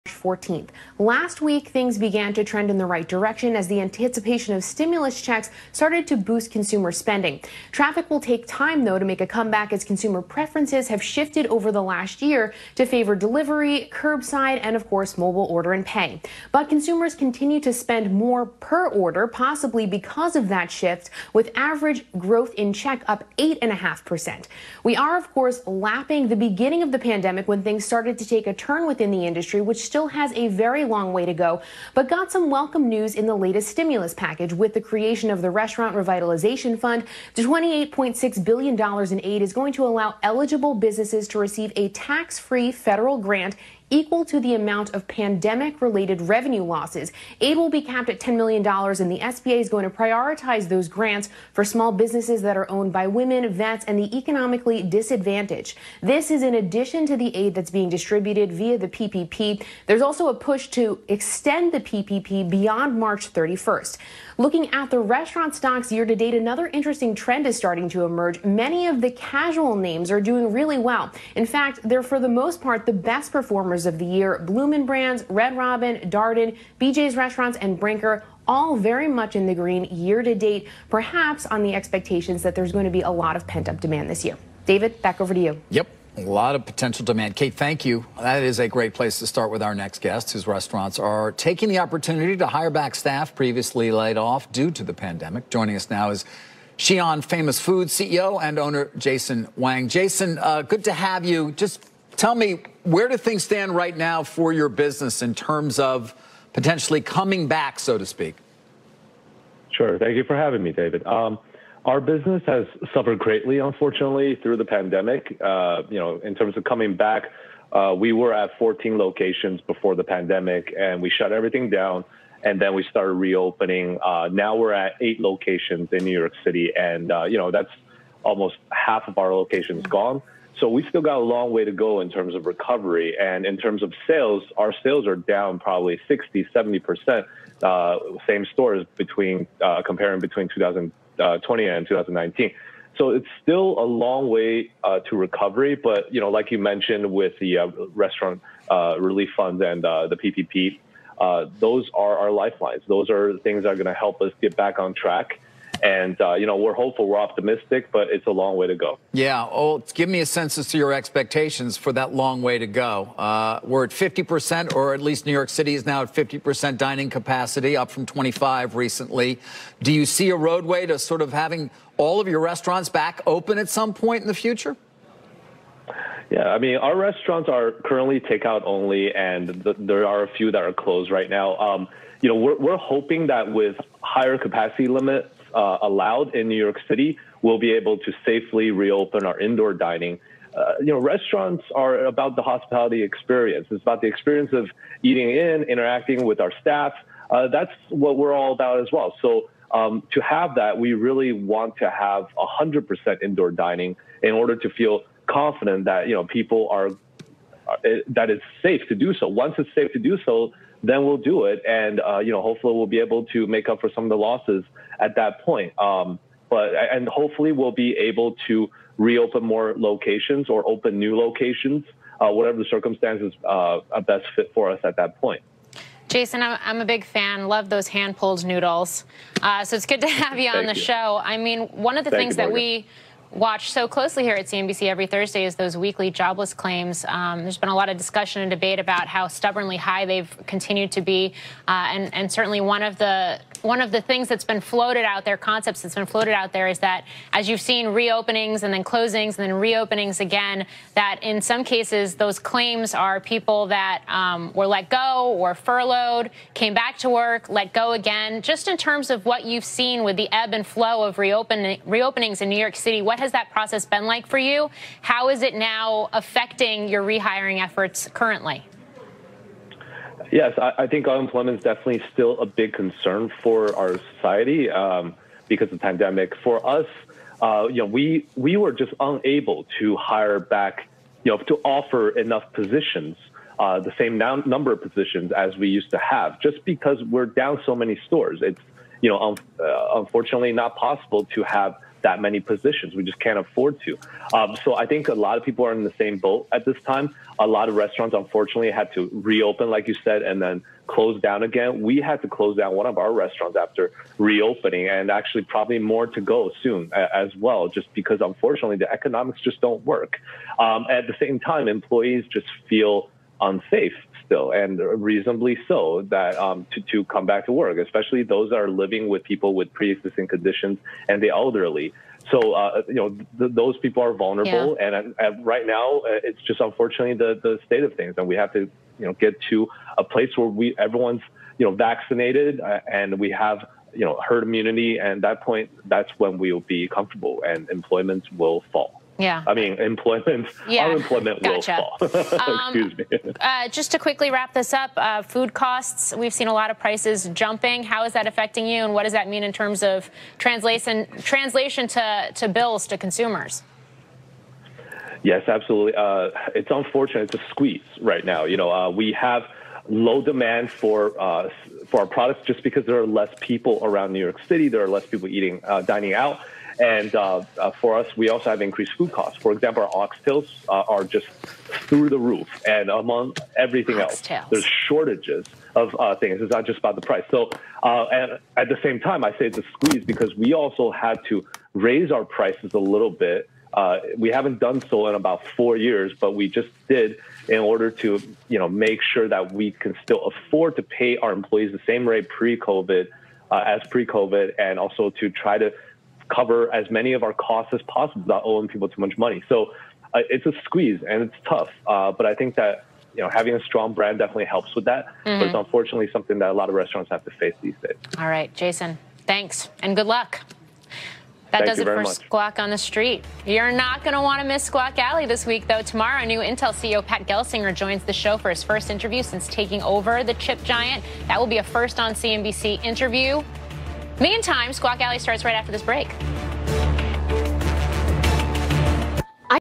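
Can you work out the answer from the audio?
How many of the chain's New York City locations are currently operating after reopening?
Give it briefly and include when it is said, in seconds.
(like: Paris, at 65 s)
8, at 125 s.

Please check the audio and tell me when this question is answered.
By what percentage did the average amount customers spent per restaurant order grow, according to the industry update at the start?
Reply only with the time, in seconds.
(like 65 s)
23 s.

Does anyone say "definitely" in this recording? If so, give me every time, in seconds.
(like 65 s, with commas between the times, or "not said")
271 s, 404 s.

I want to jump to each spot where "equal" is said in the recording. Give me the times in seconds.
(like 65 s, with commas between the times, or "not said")
43 s.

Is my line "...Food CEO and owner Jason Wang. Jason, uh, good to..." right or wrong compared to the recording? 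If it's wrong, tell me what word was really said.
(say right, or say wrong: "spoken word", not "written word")
right.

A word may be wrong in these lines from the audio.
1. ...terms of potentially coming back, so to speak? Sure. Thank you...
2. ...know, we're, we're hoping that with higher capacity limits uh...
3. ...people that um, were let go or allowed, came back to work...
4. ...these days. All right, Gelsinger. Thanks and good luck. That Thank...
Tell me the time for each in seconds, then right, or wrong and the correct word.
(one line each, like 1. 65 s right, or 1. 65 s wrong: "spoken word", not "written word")
1. 105 s right
2. 182 s right
3. 253 s wrong: "furloughed", not "allowed"
4. 407 s wrong: "Jason", not "Gelsinger".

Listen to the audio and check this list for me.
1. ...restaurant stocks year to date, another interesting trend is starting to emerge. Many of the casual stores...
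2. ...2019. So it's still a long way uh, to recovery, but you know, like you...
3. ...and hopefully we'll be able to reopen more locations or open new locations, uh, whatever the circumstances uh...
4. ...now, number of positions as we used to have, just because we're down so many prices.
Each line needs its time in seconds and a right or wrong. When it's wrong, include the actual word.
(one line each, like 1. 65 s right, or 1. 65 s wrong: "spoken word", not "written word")
1. 64 s wrong: "names", not "stores"
2. 141 s right
3. 216 s right
4. 284 s wrong: "stores", not "prices".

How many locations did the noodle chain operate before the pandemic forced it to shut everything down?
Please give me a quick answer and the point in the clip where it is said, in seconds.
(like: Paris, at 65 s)
14, at 118 s.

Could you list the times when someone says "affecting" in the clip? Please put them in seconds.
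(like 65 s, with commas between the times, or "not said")
266 s, 348 s.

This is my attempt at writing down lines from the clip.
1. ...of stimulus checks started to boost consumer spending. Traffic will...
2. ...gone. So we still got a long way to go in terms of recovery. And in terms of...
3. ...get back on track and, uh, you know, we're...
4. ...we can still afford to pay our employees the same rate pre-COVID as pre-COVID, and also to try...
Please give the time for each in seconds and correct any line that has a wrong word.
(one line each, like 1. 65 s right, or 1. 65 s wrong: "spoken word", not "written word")
1. 4 s right
2. 129 s right
3. 154 s right
4. 389 s right.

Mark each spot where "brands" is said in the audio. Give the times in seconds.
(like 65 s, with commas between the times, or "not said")
74 s, 403 s.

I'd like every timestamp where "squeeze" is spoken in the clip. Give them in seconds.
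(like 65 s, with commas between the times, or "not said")
357 s, 379 s, 400 s.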